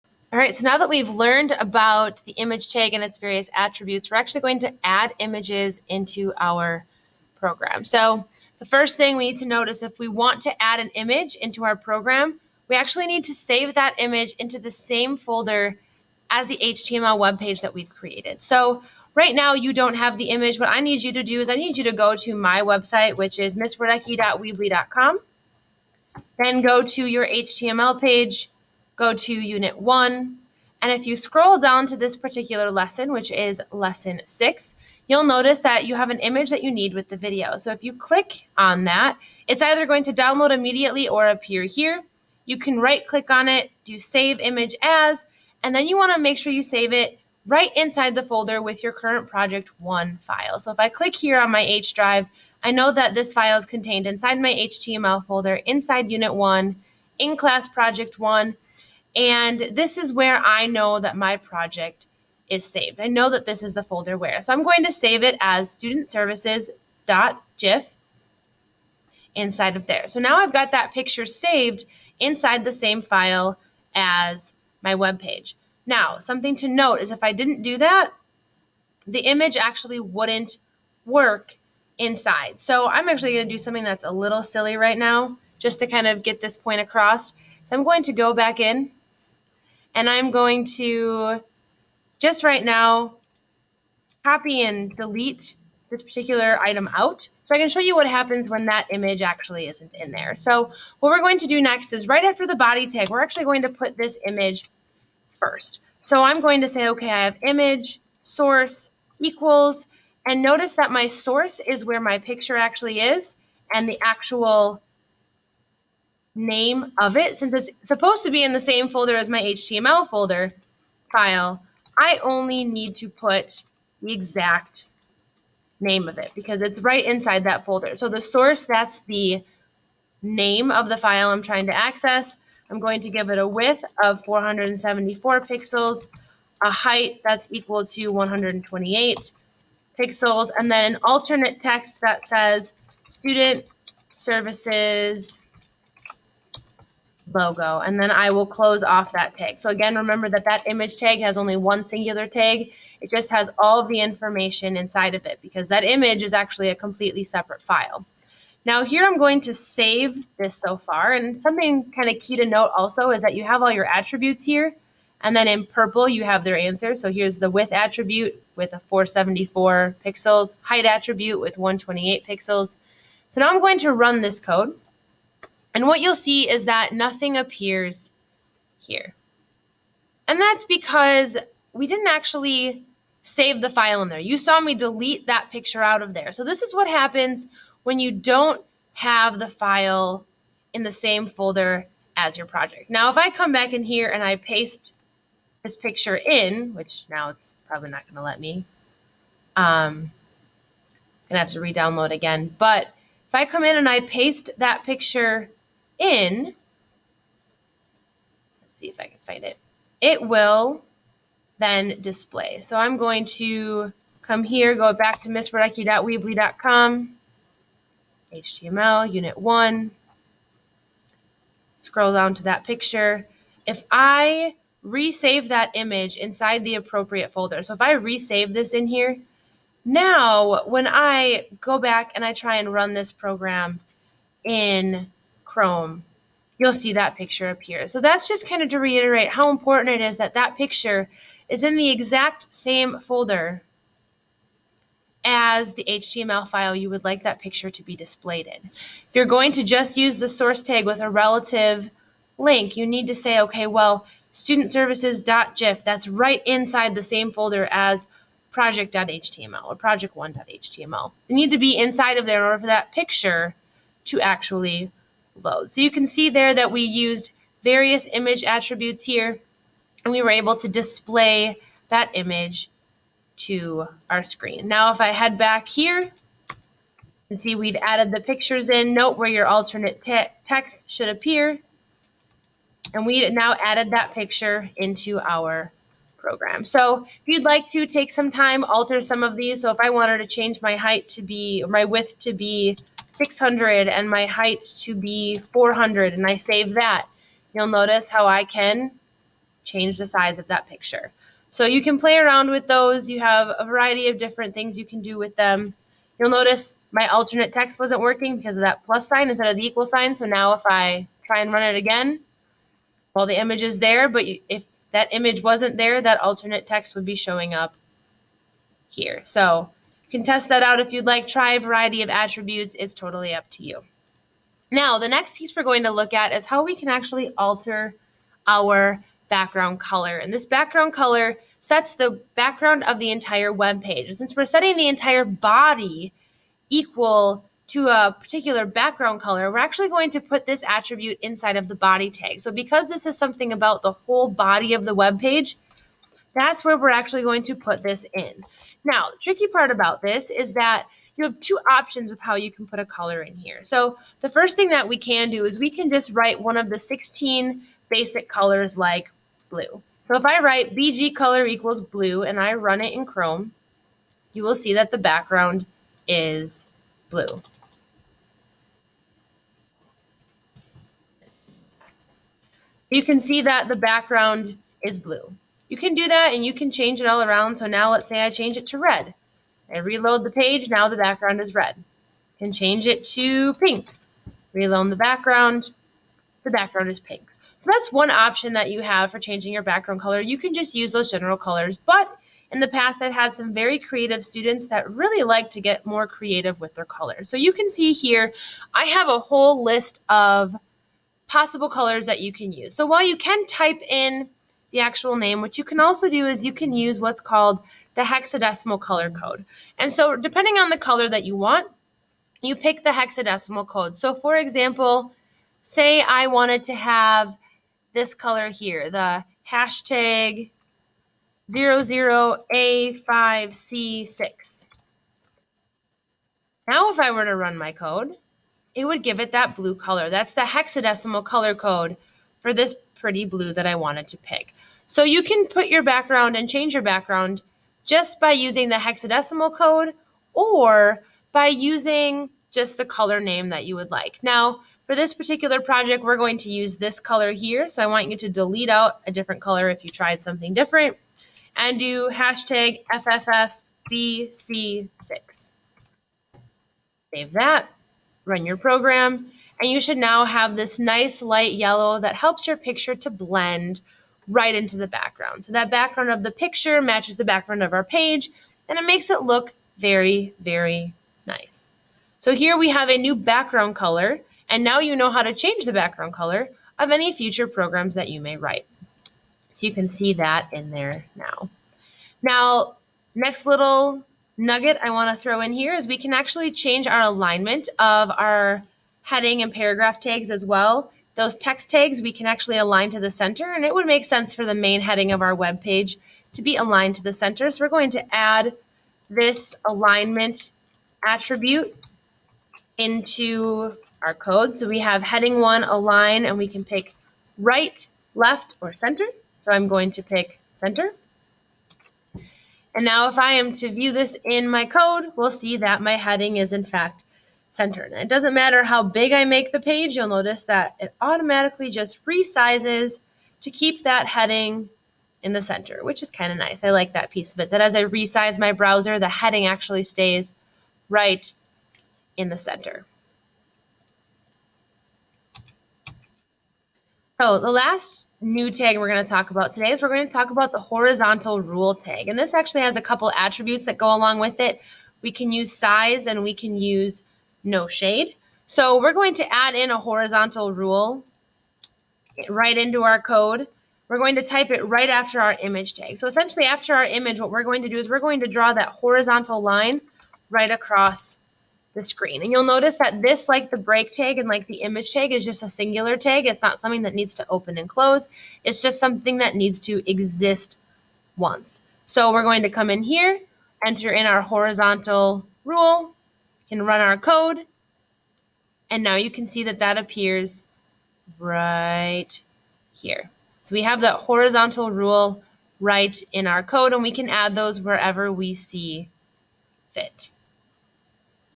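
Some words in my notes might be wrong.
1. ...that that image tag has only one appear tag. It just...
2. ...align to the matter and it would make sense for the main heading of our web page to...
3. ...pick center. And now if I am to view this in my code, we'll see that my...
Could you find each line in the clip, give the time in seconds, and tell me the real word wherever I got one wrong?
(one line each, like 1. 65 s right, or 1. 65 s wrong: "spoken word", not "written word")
1. 150 s wrong: "singular", not "appear"
2. 492 s wrong: "center", not "matter"
3. 510 s right.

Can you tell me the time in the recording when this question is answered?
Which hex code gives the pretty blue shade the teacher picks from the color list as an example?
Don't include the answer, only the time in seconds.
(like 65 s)
421 s.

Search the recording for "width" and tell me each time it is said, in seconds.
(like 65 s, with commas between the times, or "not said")
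133 s, 167 s, 291 s.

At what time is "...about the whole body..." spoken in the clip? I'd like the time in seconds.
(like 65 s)
343 s.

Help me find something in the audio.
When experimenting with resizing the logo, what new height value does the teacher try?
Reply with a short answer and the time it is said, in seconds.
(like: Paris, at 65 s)
400, at 295 s.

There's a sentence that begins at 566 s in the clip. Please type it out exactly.
It's not something that needs to open and close.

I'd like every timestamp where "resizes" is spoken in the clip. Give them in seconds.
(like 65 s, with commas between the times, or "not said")
522 s, 527 s.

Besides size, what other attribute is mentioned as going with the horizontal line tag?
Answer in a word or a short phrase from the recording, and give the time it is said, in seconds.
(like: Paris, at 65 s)
no shade, at 547 s.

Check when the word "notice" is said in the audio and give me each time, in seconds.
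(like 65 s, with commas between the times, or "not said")
9 s, 35 s, 110 s, 297 s, 306 s, 520 s, 562 s.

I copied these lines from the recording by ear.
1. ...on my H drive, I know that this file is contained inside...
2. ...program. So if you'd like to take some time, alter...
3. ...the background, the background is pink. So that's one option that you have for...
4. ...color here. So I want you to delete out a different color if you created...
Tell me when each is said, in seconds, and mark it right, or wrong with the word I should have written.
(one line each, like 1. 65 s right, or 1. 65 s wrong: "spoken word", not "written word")
1. 51 s right
2. 286 s right
3. 384 s right
4. 446 s wrong: "tried", not "created".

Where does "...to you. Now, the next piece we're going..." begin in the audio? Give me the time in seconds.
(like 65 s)
323 s.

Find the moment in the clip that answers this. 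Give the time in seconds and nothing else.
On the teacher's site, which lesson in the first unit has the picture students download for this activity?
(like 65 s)
33 s.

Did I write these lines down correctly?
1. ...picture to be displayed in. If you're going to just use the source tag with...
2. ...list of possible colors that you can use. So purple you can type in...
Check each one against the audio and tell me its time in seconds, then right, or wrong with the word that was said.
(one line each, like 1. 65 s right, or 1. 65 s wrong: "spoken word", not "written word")
1. 247 s right
2. 399 s wrong: "while", not "purple".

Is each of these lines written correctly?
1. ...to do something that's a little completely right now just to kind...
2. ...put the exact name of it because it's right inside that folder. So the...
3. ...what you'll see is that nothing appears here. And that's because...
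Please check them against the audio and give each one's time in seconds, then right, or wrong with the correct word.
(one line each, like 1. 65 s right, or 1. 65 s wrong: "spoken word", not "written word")
1. 83 s wrong: "silly", not "completely"
2. 123 s right
3. 175 s right.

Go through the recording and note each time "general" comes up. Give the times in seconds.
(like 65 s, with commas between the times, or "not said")
391 s.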